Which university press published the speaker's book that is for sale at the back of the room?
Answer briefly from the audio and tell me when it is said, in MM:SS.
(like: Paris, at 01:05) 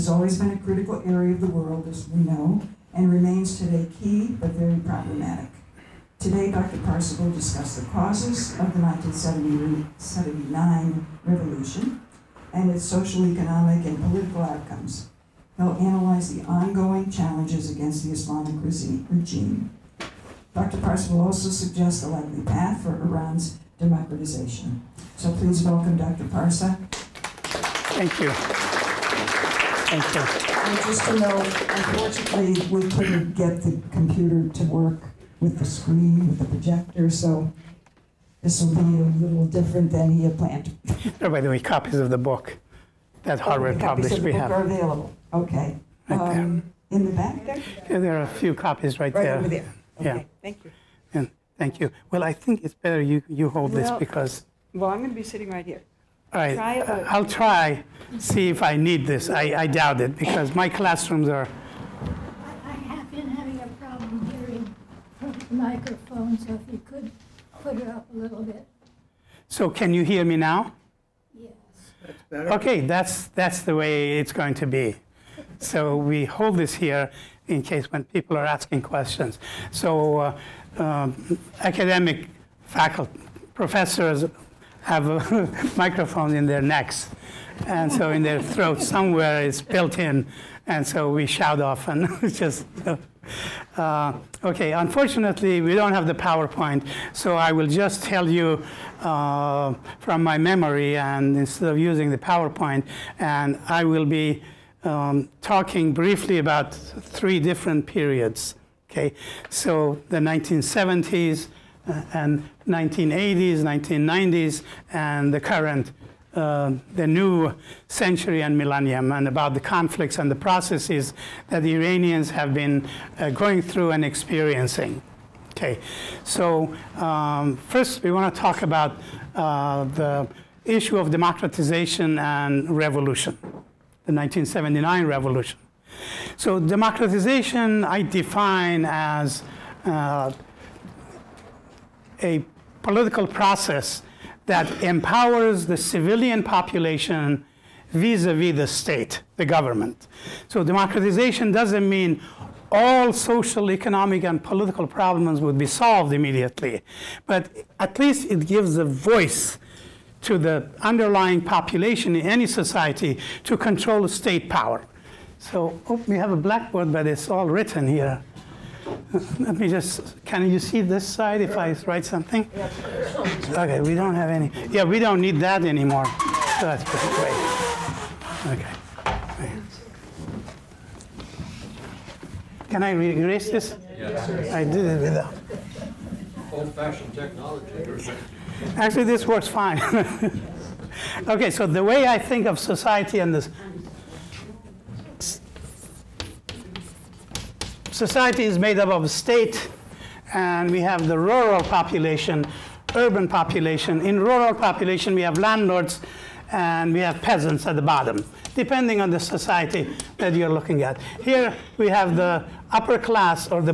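Harvard, at 00:43.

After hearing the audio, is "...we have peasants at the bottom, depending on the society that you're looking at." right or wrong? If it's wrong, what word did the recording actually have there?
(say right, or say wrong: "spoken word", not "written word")
right.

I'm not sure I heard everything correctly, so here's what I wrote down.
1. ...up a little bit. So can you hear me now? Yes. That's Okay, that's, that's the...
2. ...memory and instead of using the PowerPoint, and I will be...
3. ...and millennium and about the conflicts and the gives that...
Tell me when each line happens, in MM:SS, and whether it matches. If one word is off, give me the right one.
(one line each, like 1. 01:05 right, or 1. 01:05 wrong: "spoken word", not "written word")
1. 01:07 right
2. 01:40 right
3. 01:58 wrong: "processes", not "gives".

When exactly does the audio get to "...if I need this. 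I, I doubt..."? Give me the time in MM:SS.
00:58.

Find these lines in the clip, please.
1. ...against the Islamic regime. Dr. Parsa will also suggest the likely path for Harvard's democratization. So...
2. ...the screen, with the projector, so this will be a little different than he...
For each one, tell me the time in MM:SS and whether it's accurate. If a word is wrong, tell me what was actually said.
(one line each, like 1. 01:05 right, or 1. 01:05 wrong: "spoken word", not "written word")
1. 00:17 wrong: "Iran", not "Harvard"
2. 00:35 right.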